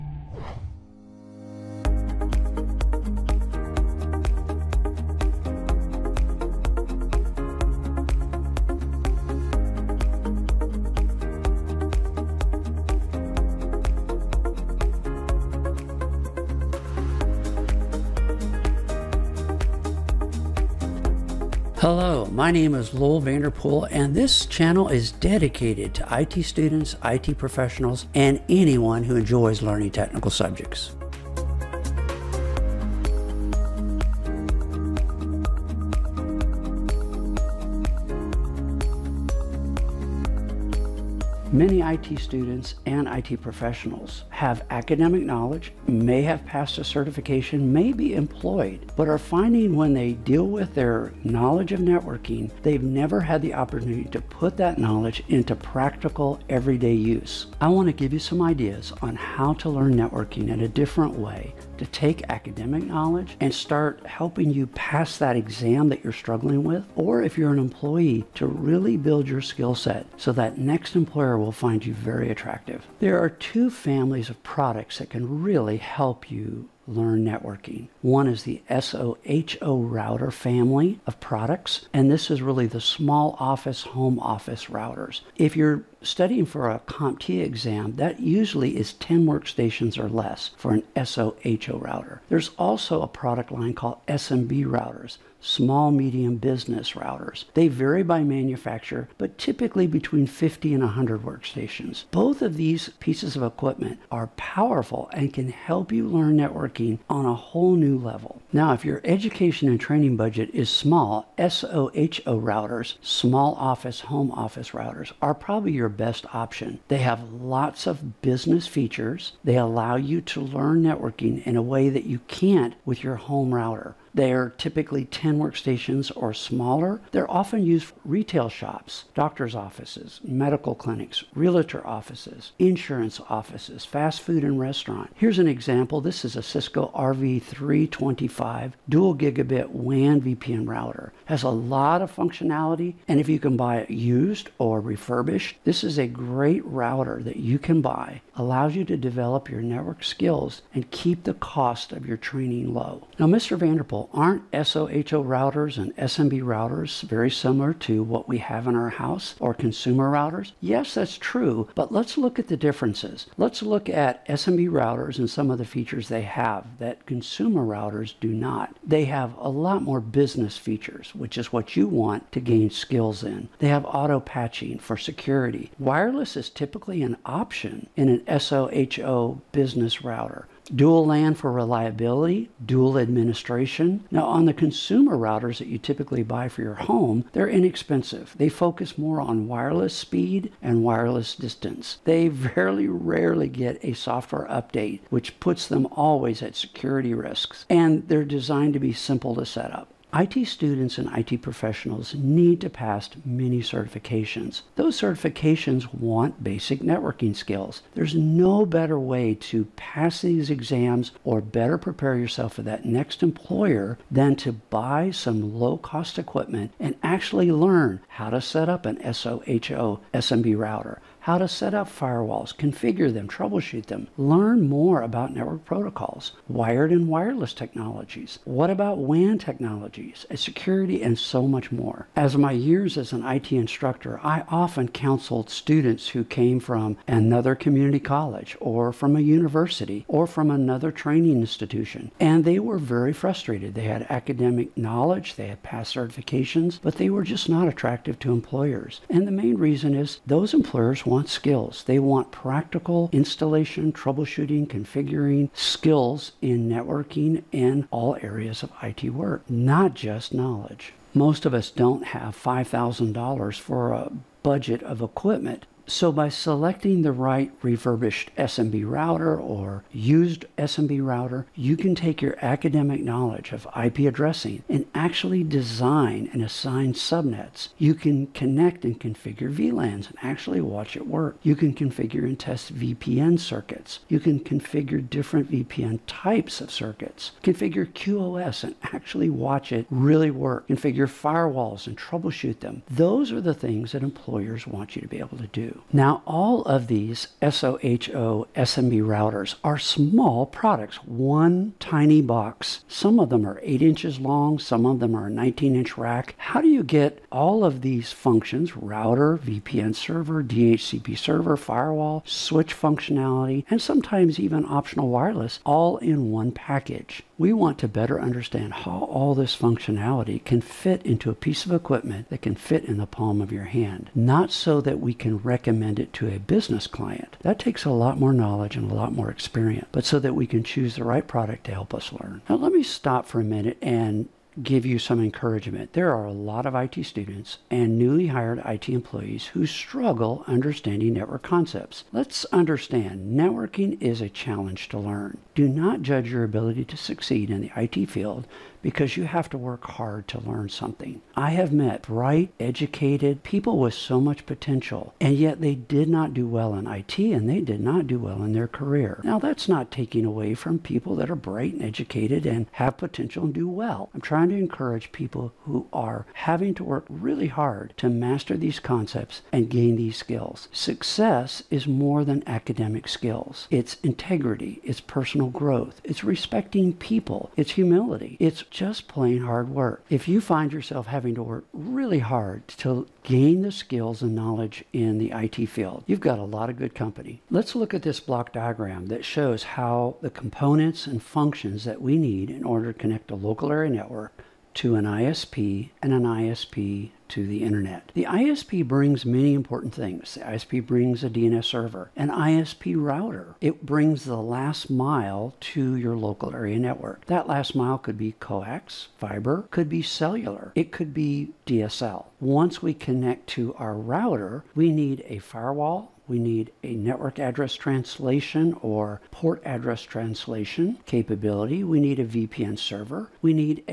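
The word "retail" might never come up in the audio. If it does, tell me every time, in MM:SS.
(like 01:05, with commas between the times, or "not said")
02:08.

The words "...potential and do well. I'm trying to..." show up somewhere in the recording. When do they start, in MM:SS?
06:02.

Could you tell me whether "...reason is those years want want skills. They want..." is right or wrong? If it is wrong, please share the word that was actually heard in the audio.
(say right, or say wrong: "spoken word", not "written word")
wrong: "employers", not "years".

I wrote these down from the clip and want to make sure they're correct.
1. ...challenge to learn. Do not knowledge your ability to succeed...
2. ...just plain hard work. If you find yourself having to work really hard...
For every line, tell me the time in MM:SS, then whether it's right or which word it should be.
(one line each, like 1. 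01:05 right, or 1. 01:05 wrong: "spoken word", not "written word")
1. 05:44 wrong: "judge", not "knowledge"
2. 06:18 right.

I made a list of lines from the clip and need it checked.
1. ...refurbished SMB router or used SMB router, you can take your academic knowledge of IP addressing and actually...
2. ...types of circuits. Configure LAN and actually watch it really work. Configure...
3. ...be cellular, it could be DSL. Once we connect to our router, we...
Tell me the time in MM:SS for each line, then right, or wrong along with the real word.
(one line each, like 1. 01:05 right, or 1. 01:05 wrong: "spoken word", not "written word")
1. 04:27 right
2. 04:46 wrong: "QoS", not "LAN"
3. 06:49 right.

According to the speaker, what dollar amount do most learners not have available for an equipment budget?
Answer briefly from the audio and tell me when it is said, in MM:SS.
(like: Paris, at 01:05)
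$5,000, at 04:22.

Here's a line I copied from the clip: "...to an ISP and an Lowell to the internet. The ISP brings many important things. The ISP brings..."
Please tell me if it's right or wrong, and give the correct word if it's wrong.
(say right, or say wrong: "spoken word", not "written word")
wrong: "ISP", not "Lowell".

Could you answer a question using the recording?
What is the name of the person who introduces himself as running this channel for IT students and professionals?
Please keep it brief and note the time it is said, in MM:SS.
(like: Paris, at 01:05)
Lowell Vanderpool, at 00:22.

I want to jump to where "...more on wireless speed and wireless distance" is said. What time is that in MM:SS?
03:08.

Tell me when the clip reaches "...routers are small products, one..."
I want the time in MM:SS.
04:59.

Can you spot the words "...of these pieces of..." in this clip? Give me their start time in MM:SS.
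01:42.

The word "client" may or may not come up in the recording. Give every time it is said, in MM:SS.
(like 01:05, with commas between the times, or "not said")
05:26.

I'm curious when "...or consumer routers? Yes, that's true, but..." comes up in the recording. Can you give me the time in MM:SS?
02:39.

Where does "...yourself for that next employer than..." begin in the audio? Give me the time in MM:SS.
03:32.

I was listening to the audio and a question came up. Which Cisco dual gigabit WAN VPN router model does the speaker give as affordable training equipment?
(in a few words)
RV325.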